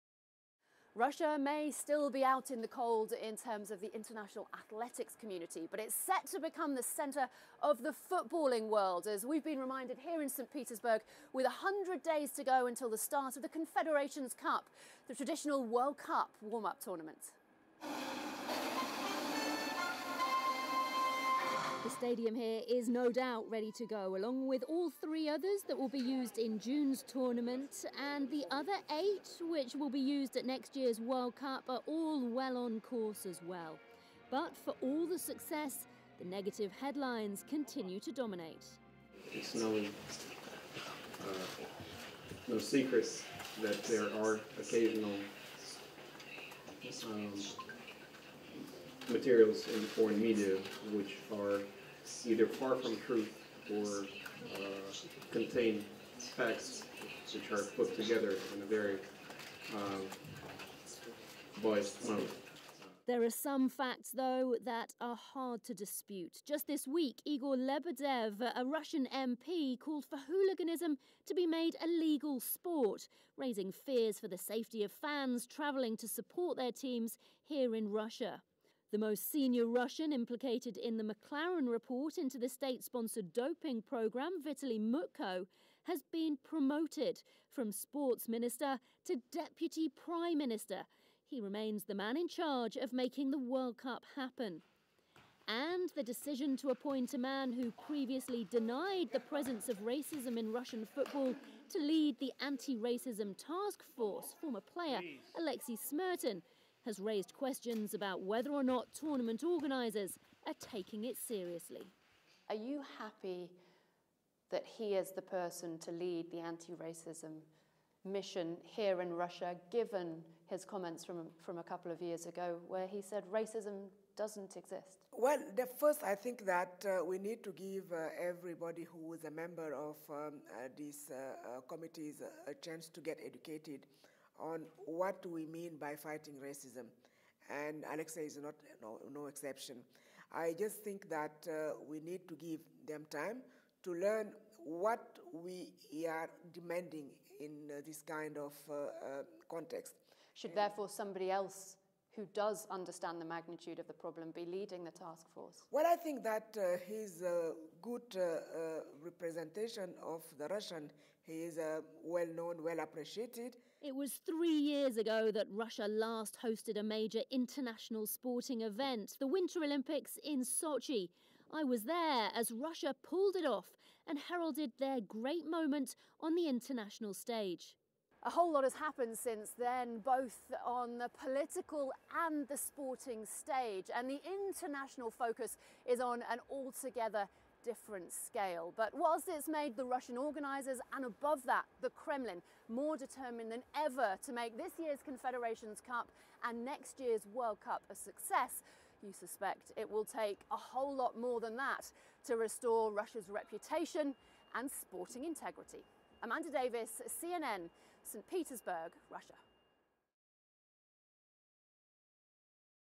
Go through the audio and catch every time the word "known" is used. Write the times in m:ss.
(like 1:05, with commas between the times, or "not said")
2:42.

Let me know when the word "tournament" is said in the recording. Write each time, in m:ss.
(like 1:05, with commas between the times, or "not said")
0:16, 0:27, 1:48.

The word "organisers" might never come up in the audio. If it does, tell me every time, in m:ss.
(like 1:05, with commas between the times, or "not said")
1:49, 3:10.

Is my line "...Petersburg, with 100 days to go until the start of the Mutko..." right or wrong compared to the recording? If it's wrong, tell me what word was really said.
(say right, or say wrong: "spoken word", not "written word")
wrong: "Confederations", not "Mutko".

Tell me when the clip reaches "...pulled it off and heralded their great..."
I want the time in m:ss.
2:53.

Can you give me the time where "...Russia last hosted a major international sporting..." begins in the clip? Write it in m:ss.
2:45.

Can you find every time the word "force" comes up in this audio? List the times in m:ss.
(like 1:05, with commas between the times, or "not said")
1:43, 2:35.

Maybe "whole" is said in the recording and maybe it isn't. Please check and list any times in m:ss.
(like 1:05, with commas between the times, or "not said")
2:58, 3:20.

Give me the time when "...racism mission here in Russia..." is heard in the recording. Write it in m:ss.
1:56.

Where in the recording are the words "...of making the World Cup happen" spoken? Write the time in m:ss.
1:32.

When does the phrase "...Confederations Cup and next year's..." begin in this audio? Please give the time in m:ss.
3:15.